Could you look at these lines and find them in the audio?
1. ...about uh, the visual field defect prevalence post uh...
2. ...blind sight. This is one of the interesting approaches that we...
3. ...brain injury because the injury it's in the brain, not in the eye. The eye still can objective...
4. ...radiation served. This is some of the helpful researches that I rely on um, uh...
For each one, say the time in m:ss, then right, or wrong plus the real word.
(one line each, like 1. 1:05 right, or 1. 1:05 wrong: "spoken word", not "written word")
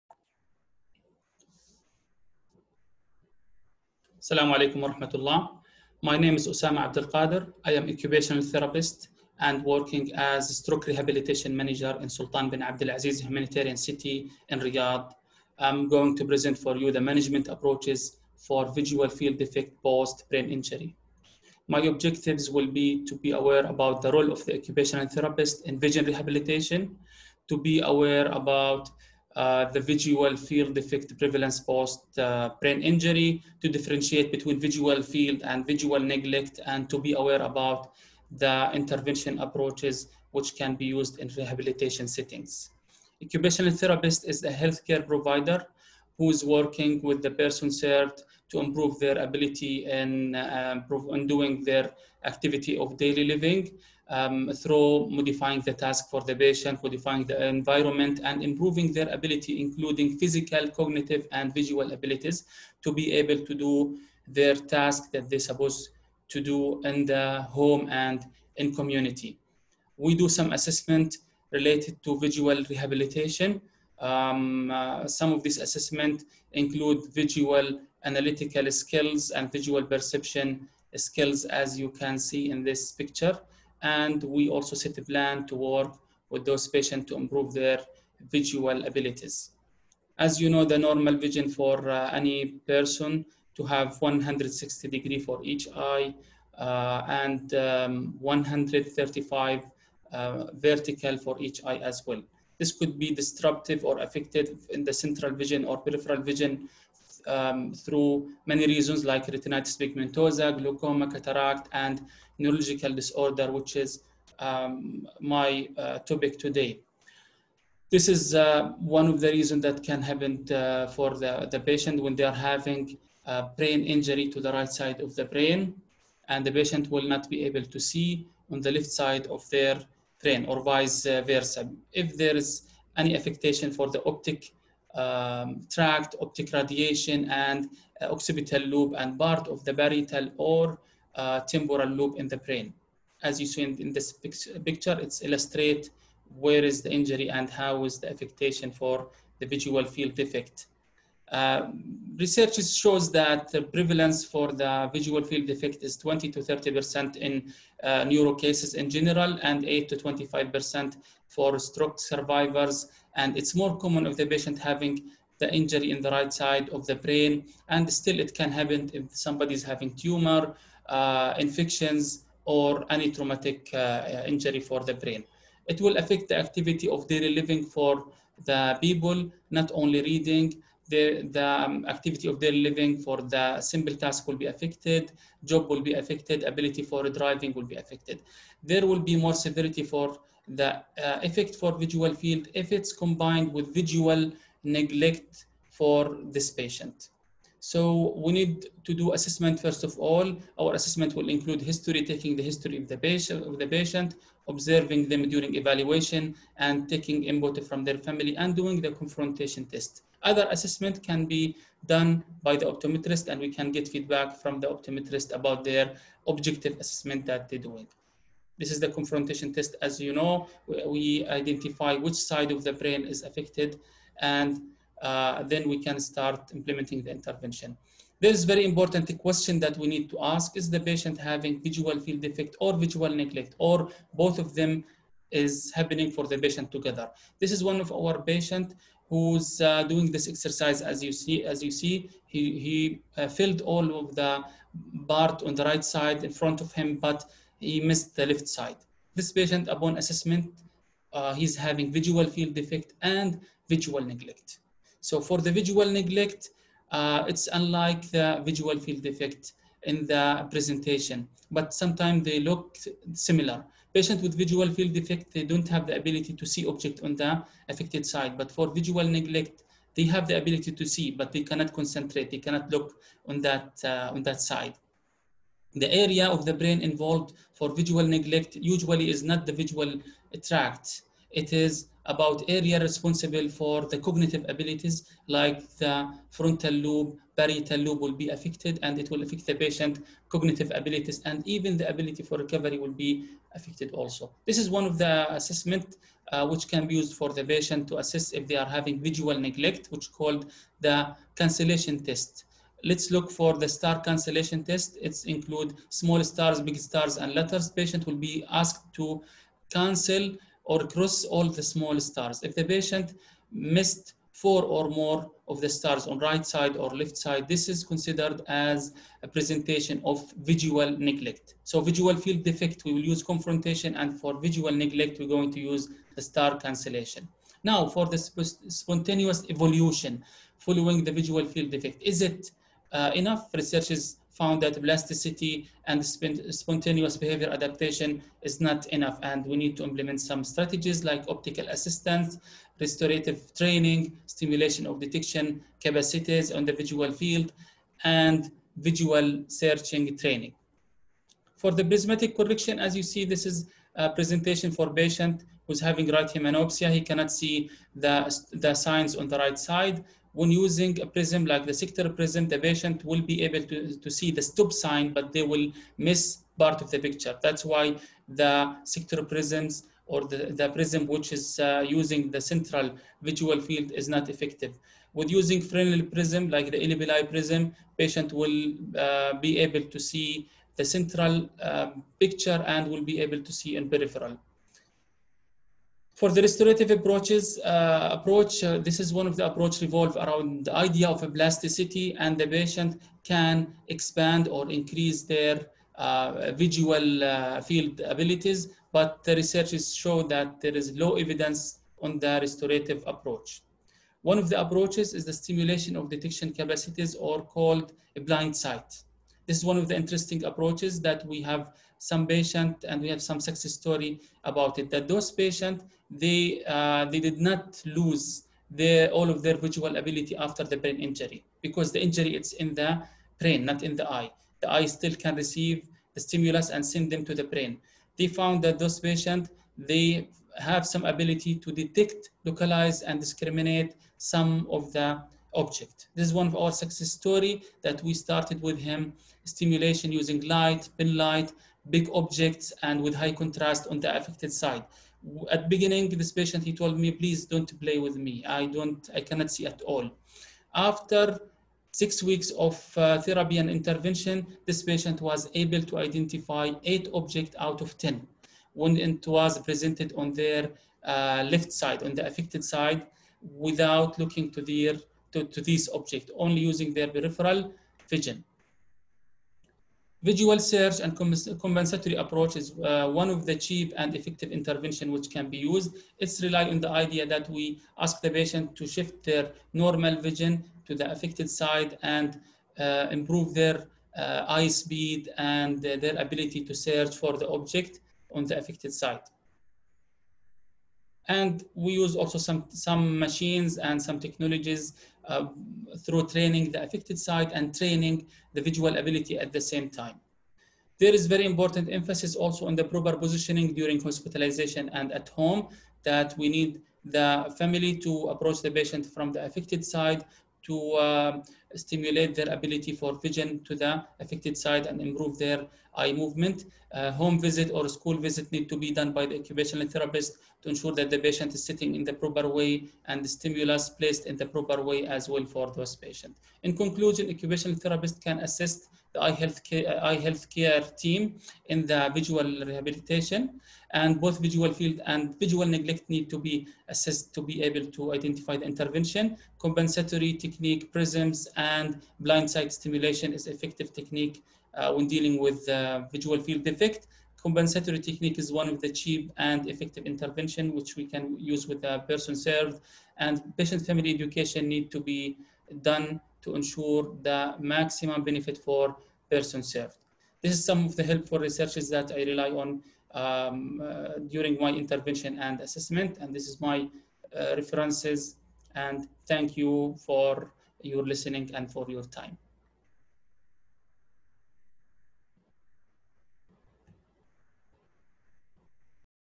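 1. 0:28 right
2. 6:48 right
3. 7:00 wrong: "receive", not "objective"
4. 9:19 wrong: "person", not "radiation".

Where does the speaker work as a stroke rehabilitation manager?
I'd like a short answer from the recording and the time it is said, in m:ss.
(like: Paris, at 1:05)
Sultan bin Aziz humanitarian city, at 0:12.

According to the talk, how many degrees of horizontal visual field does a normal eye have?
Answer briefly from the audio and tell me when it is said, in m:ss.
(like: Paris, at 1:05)
160, at 1:34.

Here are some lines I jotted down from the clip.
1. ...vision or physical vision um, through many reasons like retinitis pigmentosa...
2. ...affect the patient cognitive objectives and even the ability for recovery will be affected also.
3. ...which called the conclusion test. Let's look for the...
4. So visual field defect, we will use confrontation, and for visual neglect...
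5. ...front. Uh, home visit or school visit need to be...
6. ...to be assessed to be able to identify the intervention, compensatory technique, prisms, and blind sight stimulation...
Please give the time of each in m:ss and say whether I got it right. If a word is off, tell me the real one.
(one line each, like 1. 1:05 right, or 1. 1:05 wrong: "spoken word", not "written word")
1. 1:45 wrong: "peripheral", not "physical"
2. 4:49 wrong: "abilities", not "objectives"
3. 4:59 wrong: "cancellation", not "conclusion"
4. 5:21 right
5. 8:36 wrong: "movement", not "front"
6. 8:56 right.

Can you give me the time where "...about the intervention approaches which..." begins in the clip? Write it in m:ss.
0:37.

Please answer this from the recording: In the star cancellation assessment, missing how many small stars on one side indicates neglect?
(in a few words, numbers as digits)
4.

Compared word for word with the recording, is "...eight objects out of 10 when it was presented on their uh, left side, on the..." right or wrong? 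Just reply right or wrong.
right.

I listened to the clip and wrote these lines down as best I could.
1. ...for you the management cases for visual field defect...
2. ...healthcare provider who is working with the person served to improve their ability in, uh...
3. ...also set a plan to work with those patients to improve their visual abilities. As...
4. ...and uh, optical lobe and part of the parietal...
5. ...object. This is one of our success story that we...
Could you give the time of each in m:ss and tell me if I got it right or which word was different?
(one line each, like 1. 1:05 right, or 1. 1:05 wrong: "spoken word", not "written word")
1. 0:16 wrong: "approaches", not "cases"
2. 0:44 right
3. 1:24 right
4. 2:17 wrong: "occipital", not "optical"
5. 7:15 right.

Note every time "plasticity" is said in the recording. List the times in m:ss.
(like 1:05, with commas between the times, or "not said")
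5:34, 6:31.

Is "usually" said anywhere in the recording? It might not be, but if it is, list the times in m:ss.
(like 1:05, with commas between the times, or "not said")
4:38.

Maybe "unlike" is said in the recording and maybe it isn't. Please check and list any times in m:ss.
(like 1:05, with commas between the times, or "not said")
4:17.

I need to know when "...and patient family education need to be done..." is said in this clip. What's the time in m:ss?
9:13.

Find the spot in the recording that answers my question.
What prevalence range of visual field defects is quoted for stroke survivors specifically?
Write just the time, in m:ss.
2:39.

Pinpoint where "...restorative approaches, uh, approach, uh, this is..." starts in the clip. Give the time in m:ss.
6:26.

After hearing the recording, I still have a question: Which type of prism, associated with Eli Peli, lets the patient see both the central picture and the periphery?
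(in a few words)
Fresnel prism.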